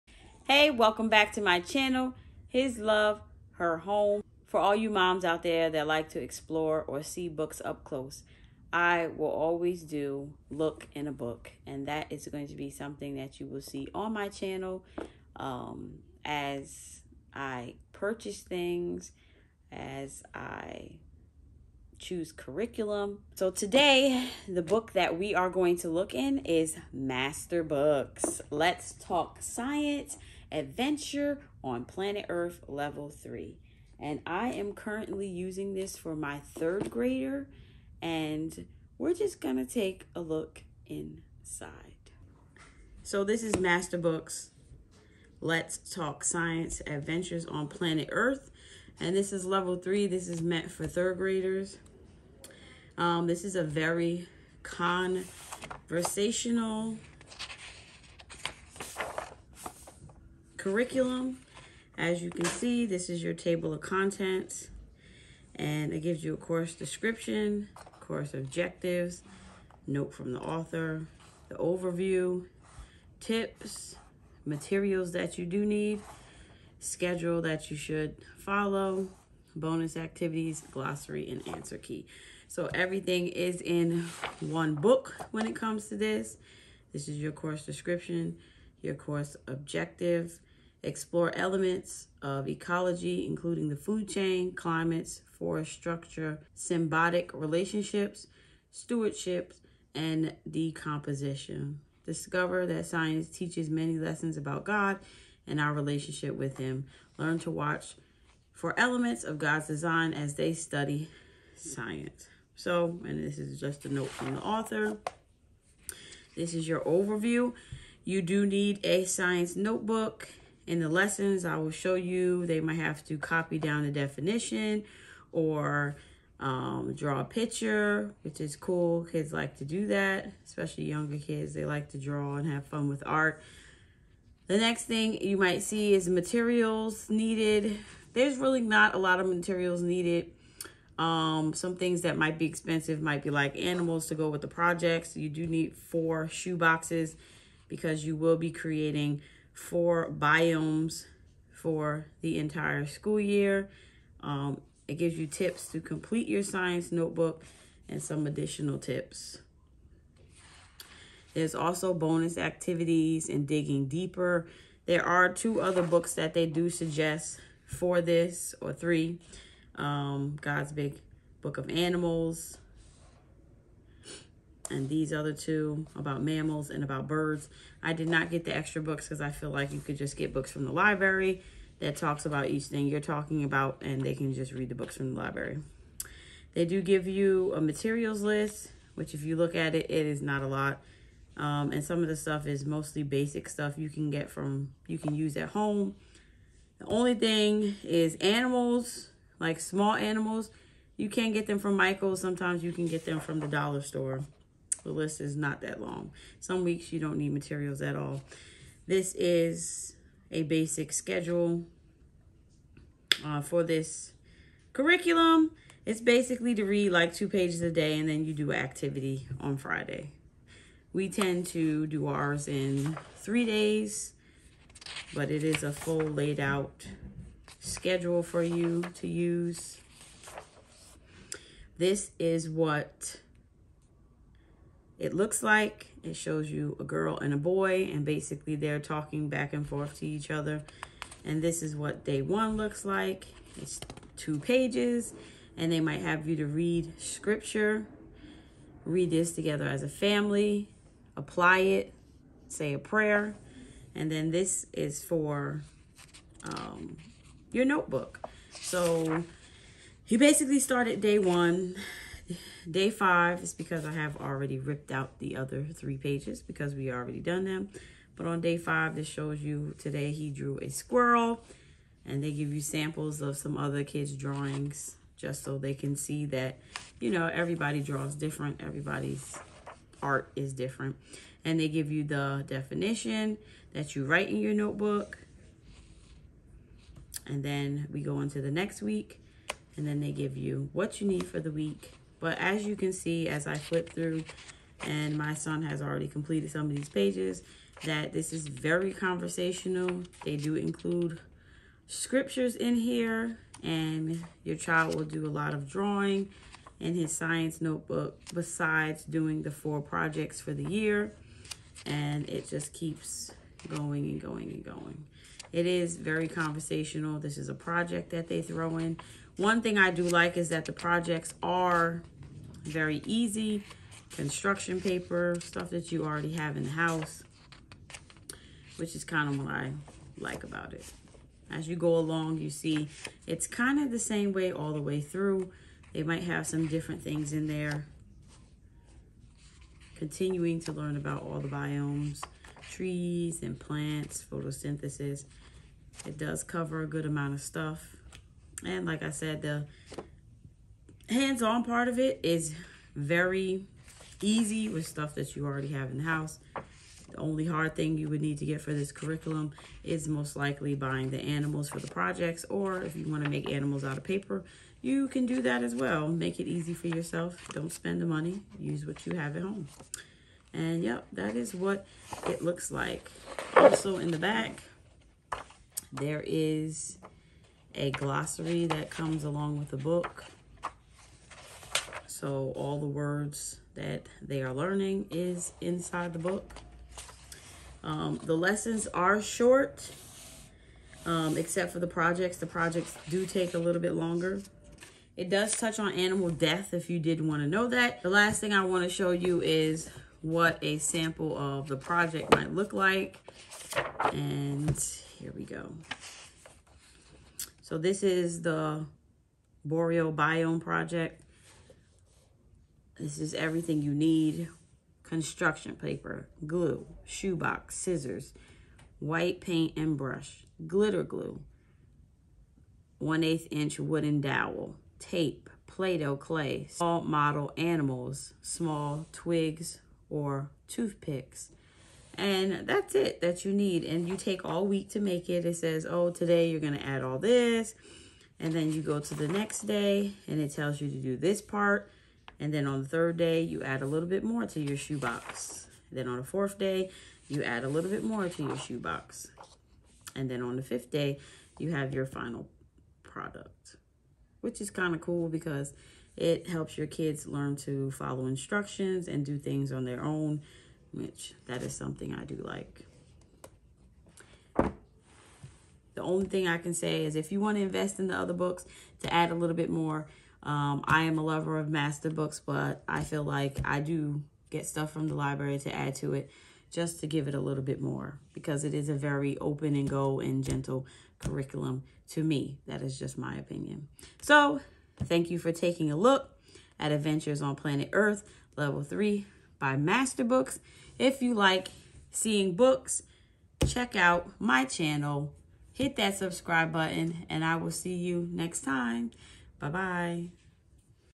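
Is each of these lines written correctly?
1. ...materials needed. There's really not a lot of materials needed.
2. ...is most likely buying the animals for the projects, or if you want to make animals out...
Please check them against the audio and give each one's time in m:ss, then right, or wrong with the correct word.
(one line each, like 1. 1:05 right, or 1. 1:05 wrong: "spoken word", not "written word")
1. 2:16 right
2. 5:59 right.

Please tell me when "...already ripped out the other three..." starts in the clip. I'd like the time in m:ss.
4:24.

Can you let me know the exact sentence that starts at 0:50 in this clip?
This is meant for third graders.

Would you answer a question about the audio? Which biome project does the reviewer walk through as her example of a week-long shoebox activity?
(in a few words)
Boreal Biome Project.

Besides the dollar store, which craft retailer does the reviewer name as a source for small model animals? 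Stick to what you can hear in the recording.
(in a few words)
Michael's.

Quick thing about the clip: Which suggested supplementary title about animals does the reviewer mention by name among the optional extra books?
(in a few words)
God's Big Book of Animals.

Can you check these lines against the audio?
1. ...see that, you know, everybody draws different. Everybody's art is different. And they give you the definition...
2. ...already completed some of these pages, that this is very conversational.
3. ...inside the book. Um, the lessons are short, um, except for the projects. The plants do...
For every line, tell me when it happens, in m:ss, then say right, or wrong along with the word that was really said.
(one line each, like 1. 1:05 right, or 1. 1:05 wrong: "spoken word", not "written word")
1. 4:35 right
2. 4:55 right
3. 6:25 wrong: "projects", not "plants".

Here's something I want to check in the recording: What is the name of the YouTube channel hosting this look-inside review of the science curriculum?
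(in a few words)
His Love, Her Home.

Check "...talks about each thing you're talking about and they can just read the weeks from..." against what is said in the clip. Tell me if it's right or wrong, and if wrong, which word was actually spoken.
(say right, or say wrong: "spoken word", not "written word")
wrong: "books", not "weeks".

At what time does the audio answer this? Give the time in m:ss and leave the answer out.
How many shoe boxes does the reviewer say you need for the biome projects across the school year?
2:25.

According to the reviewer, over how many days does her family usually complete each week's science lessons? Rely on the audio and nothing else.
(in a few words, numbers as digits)
3.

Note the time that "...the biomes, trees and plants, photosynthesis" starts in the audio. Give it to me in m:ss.
5:41.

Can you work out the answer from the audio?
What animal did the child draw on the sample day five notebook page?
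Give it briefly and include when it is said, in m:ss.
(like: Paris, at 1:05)
squirrel, at 4:30.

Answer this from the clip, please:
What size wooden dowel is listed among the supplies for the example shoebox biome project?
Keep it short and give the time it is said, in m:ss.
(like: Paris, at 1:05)
1/8 inch, at 7:02.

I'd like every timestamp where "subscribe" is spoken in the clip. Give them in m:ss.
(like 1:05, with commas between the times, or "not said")
8:16.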